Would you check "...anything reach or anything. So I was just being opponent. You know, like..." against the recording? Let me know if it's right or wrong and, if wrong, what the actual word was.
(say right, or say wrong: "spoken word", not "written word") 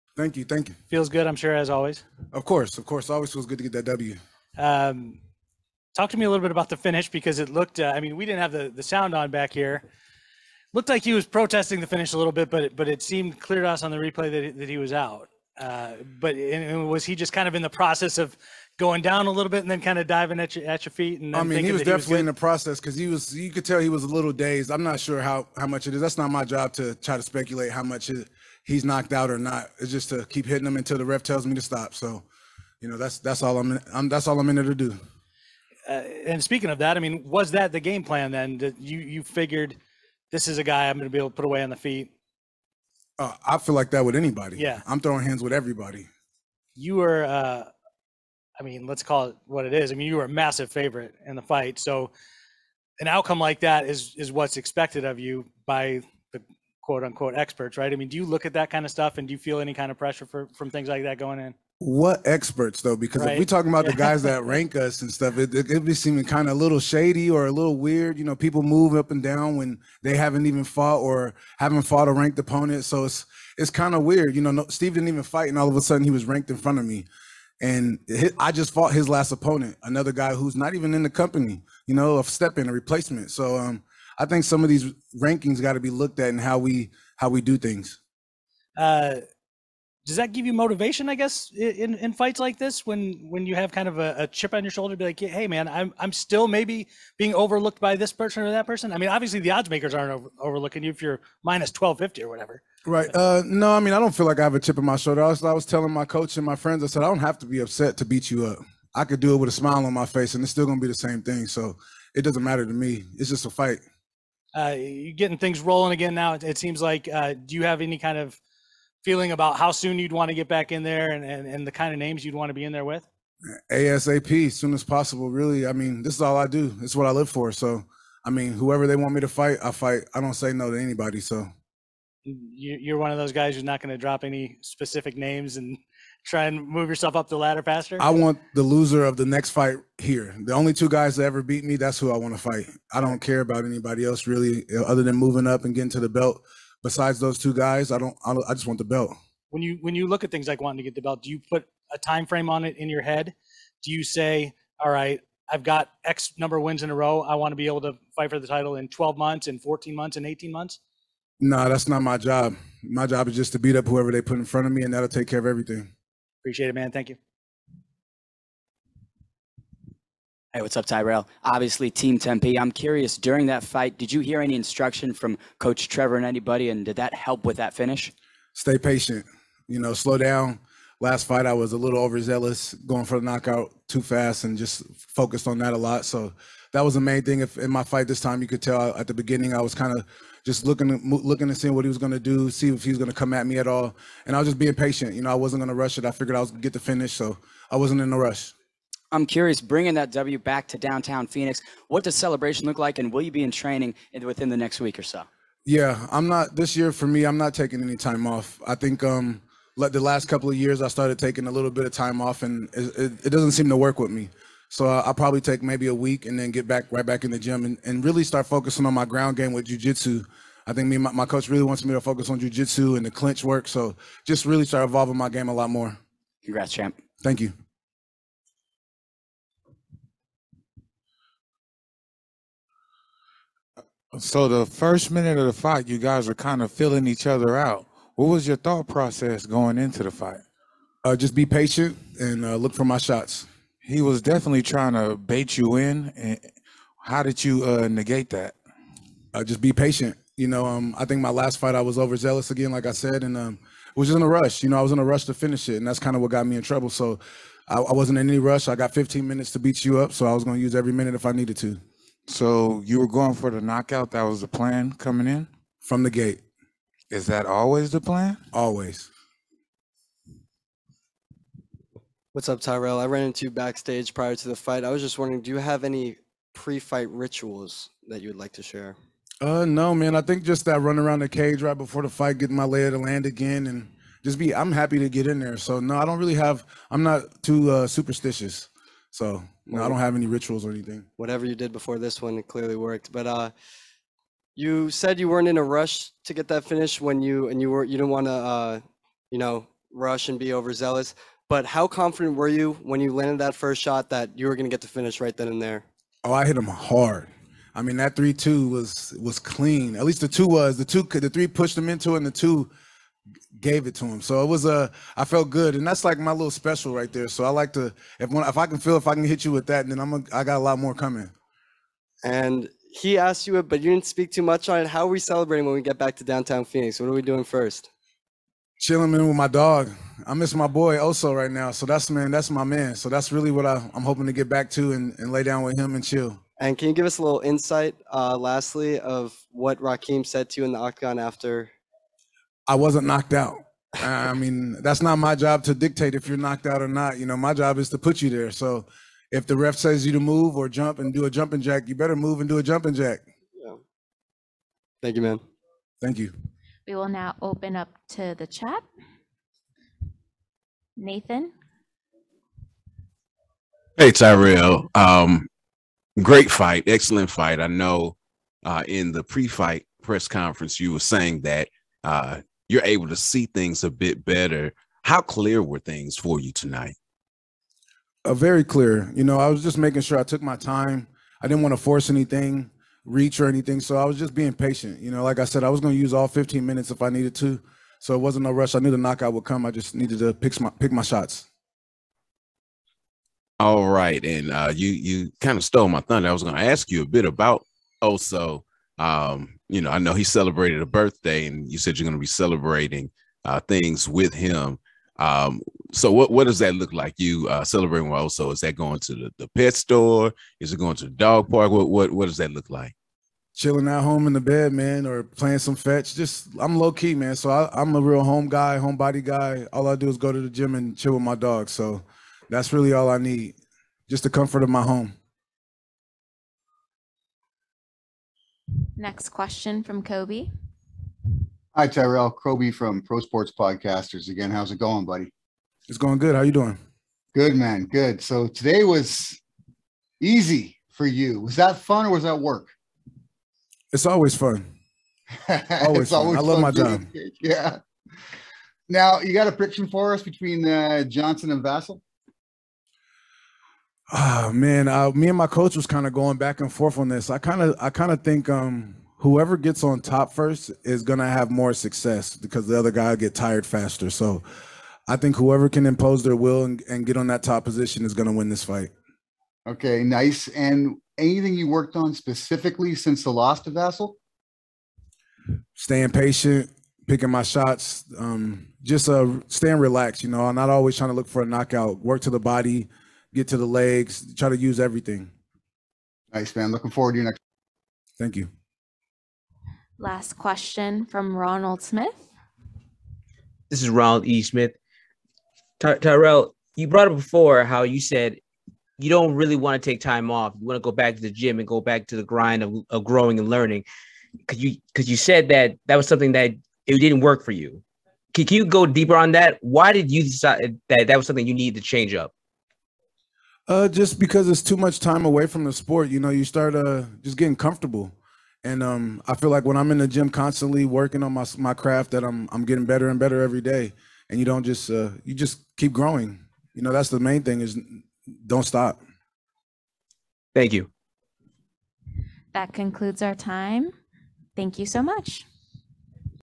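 wrong: "patient", not "opponent".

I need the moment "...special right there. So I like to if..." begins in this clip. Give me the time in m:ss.
5:16.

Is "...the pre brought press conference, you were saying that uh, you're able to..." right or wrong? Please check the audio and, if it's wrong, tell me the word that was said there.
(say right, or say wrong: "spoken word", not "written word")
wrong: "fight", not "brought".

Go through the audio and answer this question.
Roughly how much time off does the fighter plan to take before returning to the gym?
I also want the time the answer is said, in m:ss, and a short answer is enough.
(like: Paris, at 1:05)
a week, at 3:35.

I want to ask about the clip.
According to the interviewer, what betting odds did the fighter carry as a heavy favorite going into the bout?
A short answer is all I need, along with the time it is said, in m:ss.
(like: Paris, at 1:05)
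-1250, at 1:41.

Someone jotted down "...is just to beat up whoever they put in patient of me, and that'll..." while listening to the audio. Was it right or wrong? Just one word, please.
wrong.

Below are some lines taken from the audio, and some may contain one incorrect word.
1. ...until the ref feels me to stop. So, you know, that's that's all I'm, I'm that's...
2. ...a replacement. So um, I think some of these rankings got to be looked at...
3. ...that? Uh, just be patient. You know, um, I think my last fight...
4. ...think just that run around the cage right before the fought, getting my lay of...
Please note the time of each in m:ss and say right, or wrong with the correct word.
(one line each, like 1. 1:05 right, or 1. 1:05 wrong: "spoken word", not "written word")
1. 0:30 wrong: "tells", not "feels"
2. 1:22 right
3. 4:08 right
4. 4:40 wrong: "fight", not "fought".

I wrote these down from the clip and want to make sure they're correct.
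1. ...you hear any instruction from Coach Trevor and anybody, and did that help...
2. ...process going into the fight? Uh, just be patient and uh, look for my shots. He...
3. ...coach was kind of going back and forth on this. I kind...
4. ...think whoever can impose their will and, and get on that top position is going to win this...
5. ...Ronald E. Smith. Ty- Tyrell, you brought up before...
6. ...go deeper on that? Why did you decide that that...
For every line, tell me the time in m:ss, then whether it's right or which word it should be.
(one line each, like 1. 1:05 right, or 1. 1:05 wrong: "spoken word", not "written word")
1. 2:54 right
2. 3:58 right
3. 7:35 right
4. 7:45 right
5. 8:13 right
6. 8:28 right.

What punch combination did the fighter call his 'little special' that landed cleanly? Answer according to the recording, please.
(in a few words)
three two.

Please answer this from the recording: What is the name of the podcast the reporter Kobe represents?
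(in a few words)
Pro Sports Podcasters.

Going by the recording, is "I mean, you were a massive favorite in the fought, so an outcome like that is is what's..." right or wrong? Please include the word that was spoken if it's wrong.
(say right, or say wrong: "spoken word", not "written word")
wrong: "fight", not "fought".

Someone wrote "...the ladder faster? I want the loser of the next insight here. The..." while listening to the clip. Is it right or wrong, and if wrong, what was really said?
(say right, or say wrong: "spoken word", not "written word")
wrong: "fight", not "insight".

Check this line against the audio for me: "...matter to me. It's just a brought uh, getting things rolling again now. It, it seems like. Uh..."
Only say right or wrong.
wrong.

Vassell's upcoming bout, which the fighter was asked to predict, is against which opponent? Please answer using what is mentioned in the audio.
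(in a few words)
Johnson.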